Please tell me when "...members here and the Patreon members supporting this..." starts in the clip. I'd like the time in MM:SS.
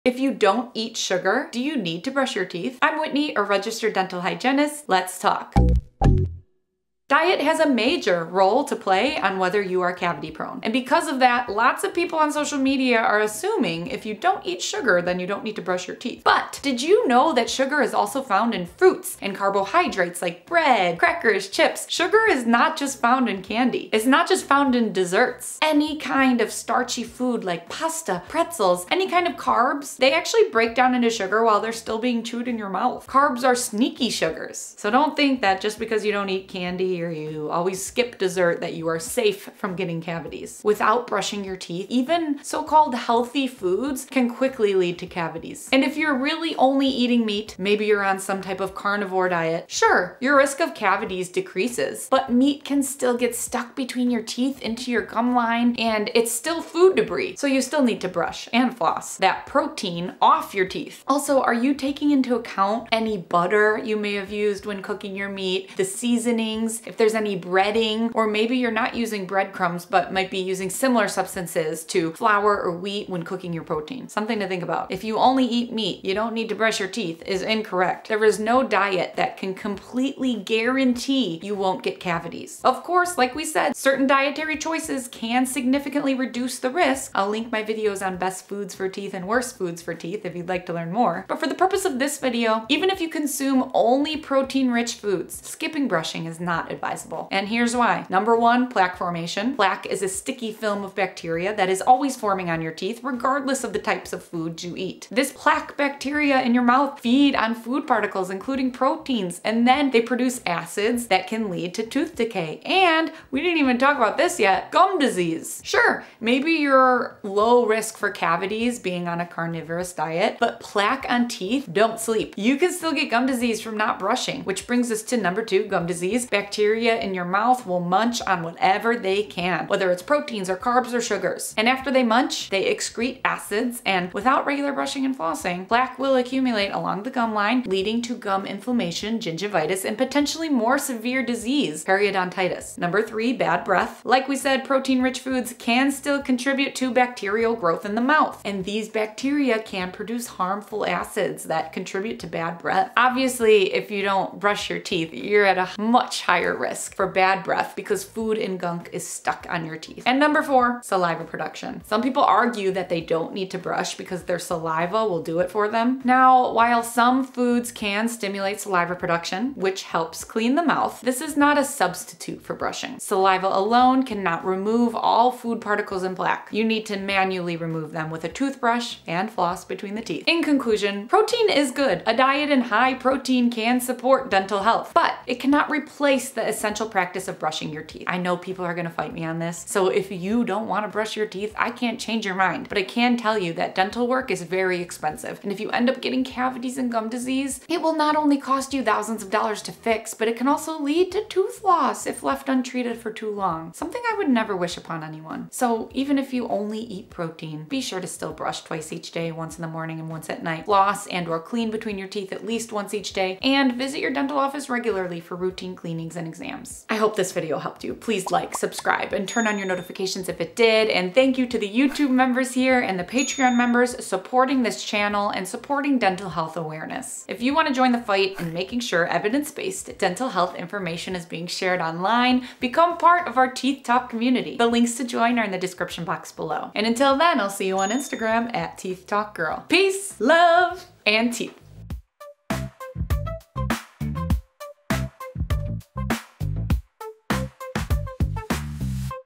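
03:42.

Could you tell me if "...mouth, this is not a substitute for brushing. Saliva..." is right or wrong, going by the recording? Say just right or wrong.
right.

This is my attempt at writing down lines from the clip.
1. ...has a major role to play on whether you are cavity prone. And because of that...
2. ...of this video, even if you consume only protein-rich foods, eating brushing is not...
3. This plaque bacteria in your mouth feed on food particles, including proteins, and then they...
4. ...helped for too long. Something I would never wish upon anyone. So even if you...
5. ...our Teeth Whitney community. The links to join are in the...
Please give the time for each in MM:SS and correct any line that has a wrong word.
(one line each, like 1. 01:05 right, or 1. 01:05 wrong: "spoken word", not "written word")
1. 00:07 right
2. 01:31 wrong: "skipping", not "eating"
3. 01:45 right
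4. 03:22 wrong: "untreated", not "helped"
5. 03:53 wrong: "Talk", not "Whitney".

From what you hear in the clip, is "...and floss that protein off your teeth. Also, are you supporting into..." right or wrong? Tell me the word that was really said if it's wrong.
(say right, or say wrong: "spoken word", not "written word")
wrong: "taking", not "supporting".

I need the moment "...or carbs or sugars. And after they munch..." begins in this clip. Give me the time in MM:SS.
02:10.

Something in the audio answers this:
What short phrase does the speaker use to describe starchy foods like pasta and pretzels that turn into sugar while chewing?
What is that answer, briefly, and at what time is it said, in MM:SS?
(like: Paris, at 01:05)
sneaky sugars, at 00:33.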